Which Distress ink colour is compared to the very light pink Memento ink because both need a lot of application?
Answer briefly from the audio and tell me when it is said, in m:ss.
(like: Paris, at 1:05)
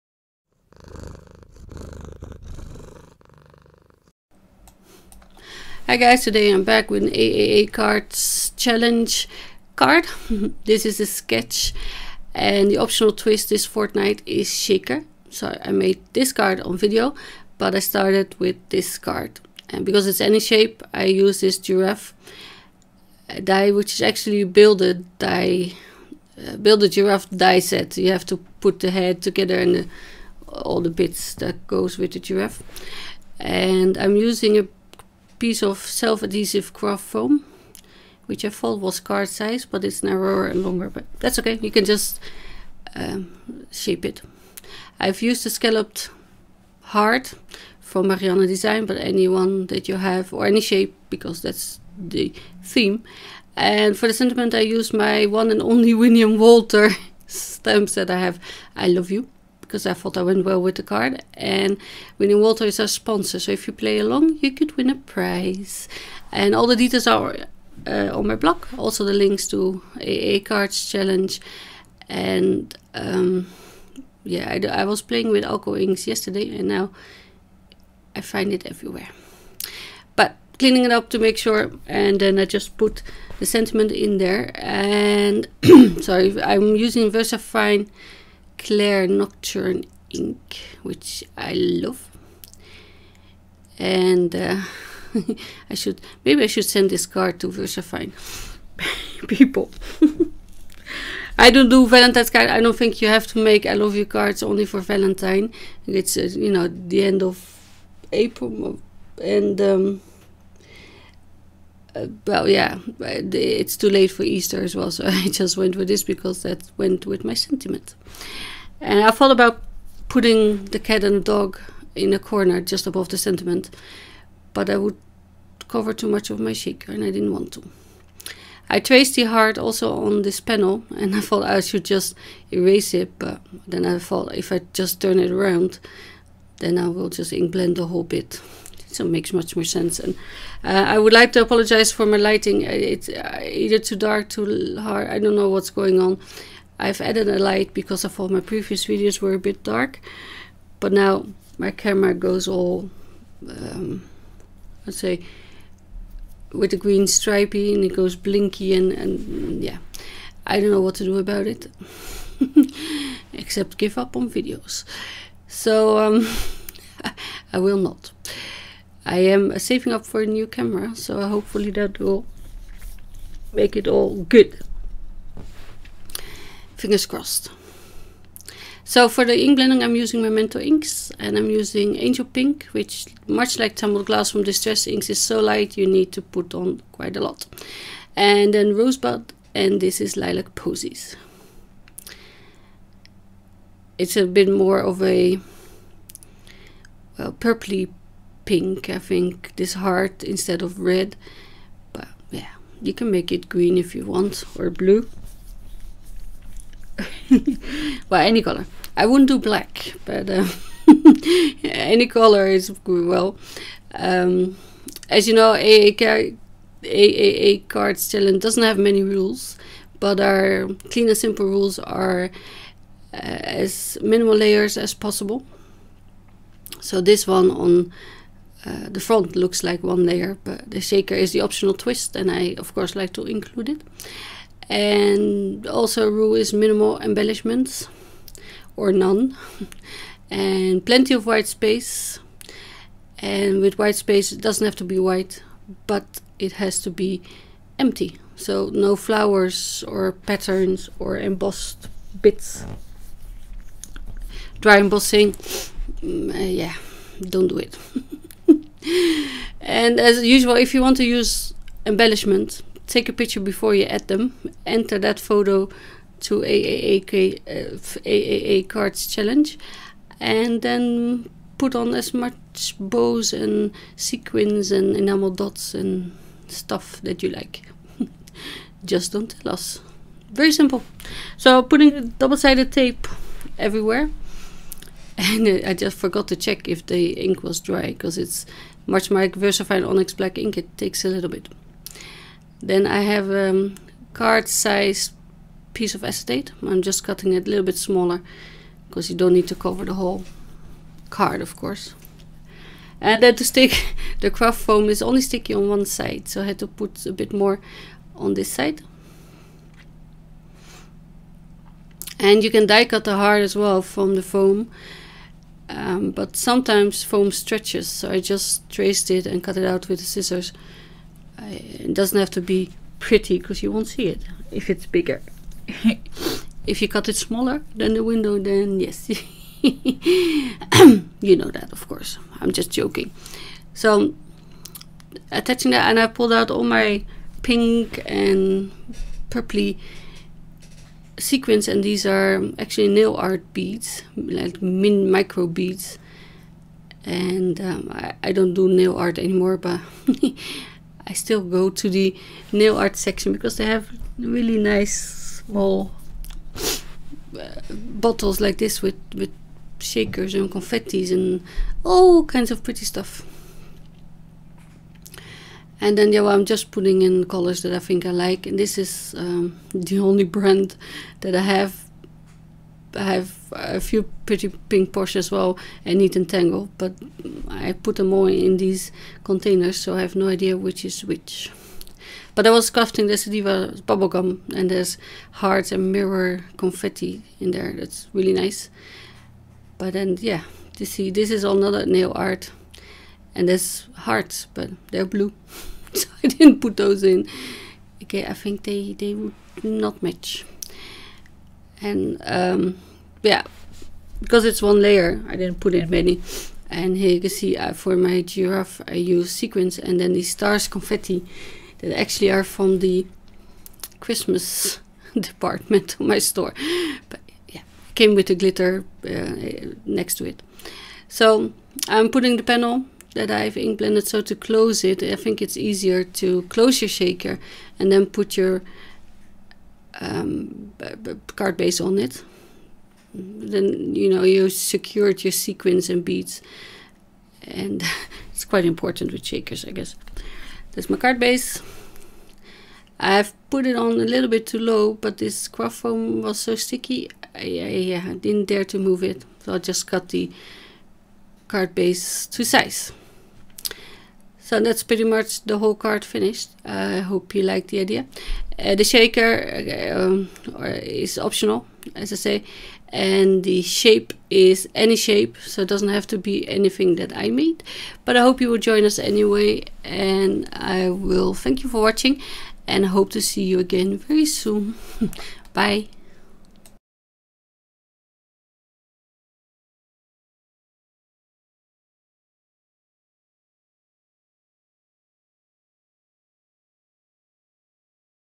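Tumbled Glass, at 3:03.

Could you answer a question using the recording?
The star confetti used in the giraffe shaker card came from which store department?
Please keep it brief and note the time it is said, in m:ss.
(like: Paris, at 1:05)
Christmas, at 6:53.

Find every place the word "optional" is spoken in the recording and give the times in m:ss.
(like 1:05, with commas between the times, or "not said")
0:12, 3:51, 7:41.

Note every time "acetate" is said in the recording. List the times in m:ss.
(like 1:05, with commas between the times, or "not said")
4:56.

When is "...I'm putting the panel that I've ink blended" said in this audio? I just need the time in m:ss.
7:01.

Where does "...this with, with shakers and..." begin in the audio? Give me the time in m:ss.
5:58.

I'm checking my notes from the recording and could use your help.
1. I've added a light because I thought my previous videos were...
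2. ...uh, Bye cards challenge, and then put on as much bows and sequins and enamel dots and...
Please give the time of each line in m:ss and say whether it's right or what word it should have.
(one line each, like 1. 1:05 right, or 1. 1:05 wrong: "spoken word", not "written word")
1. 2:26 right
2. 4:27 wrong: "AAA", not "Bye".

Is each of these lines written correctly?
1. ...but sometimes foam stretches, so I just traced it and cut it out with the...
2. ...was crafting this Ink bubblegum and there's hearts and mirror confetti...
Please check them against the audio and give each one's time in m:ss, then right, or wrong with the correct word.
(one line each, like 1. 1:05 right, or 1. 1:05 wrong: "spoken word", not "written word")
1. 5:16 right
2. 6:22 wrong: "Diva", not "Ink".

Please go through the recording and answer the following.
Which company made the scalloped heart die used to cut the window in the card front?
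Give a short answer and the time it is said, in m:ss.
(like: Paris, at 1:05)
Marianne Design, at 0:48.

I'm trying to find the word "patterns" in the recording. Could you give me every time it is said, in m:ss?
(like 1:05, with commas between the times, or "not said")
4:10.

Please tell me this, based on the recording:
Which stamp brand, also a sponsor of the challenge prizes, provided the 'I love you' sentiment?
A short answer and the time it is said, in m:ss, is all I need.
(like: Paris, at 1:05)
Winnie and Walter, at 0:55.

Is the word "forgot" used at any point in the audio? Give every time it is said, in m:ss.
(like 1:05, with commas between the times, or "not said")
4:45.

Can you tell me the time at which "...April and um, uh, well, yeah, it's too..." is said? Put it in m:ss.
1:48.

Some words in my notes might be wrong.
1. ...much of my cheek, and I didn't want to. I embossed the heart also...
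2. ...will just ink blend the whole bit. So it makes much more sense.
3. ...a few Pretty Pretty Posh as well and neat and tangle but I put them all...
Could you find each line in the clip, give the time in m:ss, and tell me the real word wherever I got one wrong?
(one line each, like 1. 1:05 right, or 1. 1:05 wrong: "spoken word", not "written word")
1. 2:06 wrong: "traced", not "embossed"
2. 2:16 right
3. 6:13 wrong: "Pink", not "Pretty".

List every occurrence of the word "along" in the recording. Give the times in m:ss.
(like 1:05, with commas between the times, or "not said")
1:03.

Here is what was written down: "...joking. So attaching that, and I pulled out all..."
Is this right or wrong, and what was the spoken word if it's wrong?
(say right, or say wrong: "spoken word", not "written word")
right.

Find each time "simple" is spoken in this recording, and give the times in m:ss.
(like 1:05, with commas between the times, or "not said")
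3:41, 4:40.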